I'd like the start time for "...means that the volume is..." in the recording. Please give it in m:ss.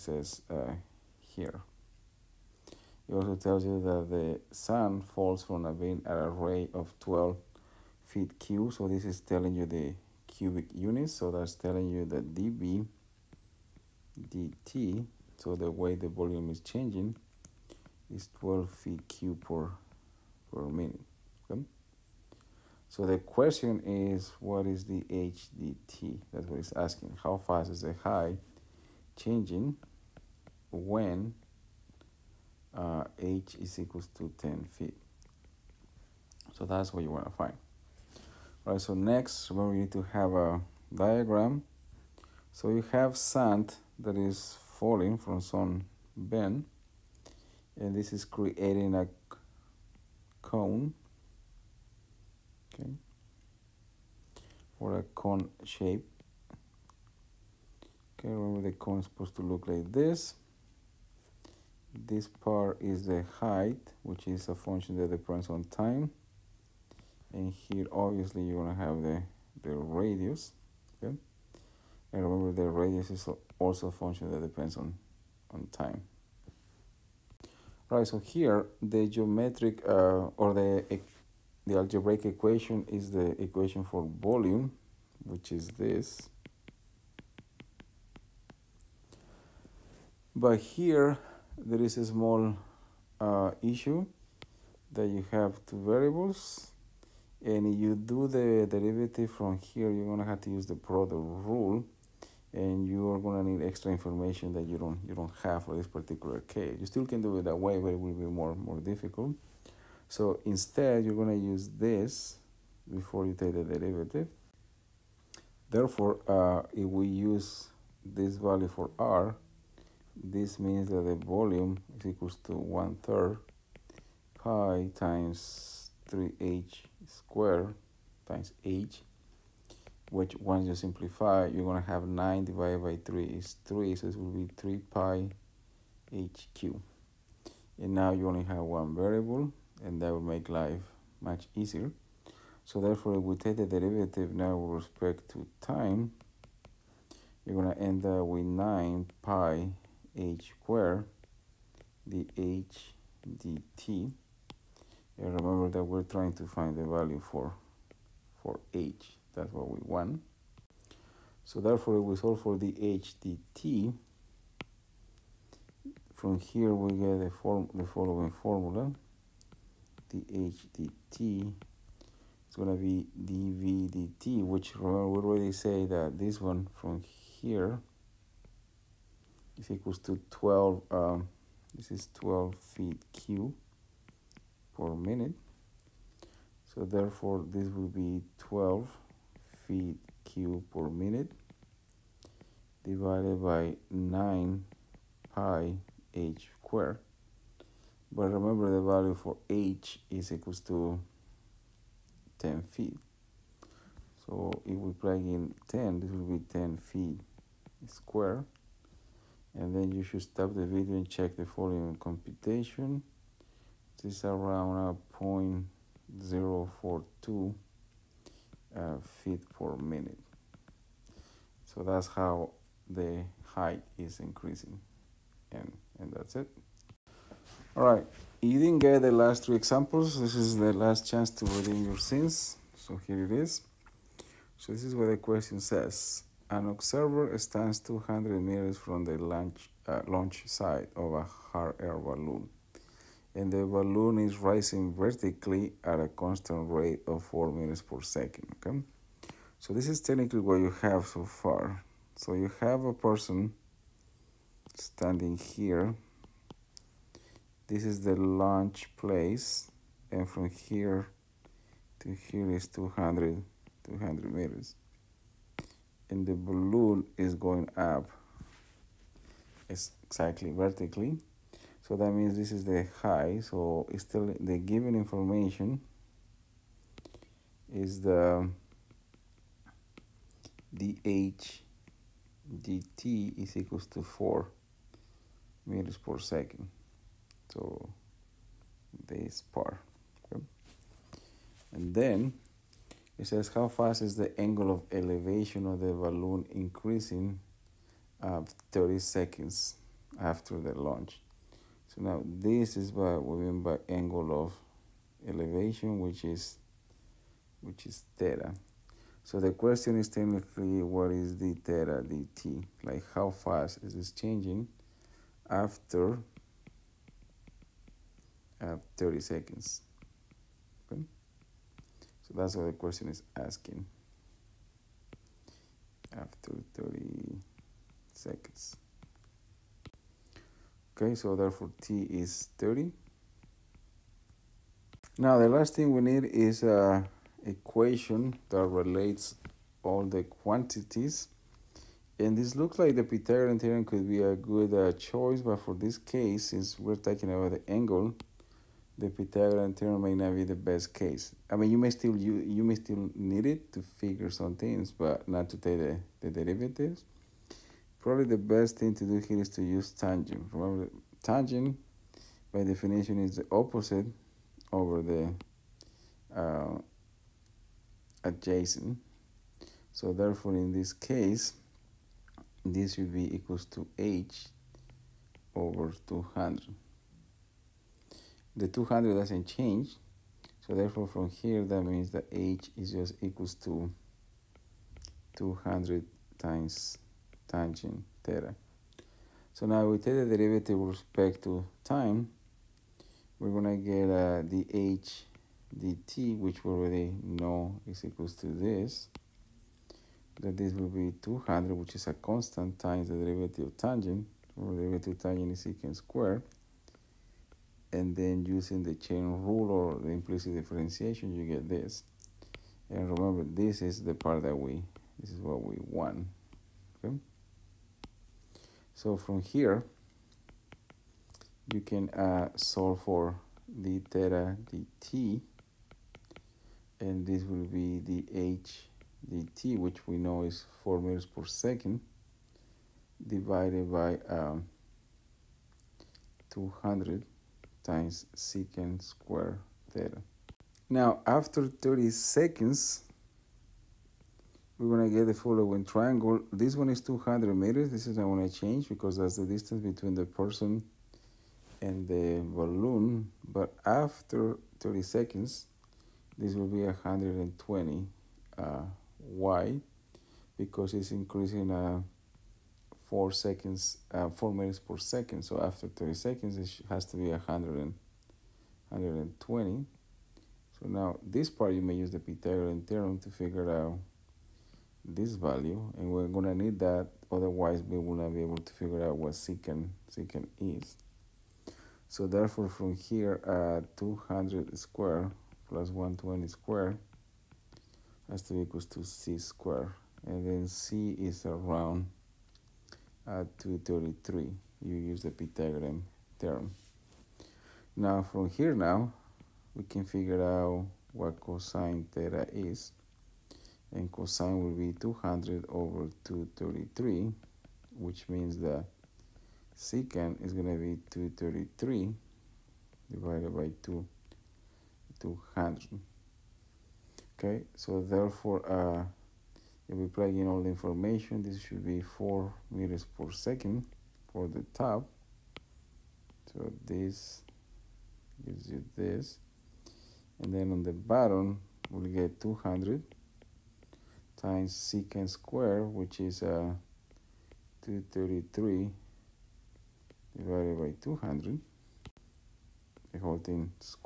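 2:00.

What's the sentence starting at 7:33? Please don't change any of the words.
But after 30 seconds, this will be 120 uh, y because it's increasing uh, four seconds, uh, four minutes per second.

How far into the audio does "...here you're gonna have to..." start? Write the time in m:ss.
1:39.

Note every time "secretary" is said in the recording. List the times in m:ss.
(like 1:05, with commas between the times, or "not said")
not said.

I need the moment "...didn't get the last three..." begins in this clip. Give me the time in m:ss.
3:48.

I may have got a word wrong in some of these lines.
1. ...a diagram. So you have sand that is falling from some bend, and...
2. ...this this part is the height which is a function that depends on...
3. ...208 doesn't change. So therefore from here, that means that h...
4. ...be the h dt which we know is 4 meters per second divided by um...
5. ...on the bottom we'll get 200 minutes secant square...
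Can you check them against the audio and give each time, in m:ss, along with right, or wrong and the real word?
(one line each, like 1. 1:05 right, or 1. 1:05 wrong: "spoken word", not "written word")
1. 0:40 right
2. 0:59 right
3. 6:18 wrong: "200", not "208"
4. 7:07 right
5. 8:50 wrong: "times", not "minutes".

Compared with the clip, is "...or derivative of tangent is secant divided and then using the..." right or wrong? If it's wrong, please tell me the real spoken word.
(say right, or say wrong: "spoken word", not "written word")
wrong: "squared", not "divided".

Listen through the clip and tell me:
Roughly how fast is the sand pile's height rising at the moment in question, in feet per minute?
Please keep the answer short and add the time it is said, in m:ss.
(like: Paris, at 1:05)
0.042, at 3:35.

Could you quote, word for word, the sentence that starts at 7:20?
Now, after 30 seconds, we're going to get the following triangle.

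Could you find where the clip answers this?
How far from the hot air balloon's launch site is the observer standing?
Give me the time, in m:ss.
4:22.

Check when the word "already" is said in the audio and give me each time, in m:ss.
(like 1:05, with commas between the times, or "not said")
2:55, 6:36.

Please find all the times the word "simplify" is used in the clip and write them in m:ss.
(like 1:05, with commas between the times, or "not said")
2:10.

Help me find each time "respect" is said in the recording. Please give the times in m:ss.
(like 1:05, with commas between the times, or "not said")
2:24, 6:30.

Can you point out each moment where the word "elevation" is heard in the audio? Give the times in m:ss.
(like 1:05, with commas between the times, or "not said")
4:54, 5:05.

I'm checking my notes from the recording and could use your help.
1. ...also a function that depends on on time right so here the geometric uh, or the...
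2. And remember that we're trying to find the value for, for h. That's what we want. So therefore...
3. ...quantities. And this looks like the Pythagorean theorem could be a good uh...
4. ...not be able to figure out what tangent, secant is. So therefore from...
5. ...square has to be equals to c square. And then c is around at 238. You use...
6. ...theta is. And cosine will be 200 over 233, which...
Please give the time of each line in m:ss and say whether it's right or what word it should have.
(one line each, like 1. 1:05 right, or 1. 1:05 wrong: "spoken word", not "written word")
1. 1:13 right
2. 2:35 right
3. 5:40 right
4. 7:58 wrong: "secant", not "tangent"
5. 8:06 wrong: "233", not "238"
6. 8:22 right.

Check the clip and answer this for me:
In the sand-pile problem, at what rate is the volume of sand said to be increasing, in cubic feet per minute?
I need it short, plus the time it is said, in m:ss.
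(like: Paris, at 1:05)
12, at 0:18.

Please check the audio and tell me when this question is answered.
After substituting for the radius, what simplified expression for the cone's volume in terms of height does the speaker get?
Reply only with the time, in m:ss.
2:14.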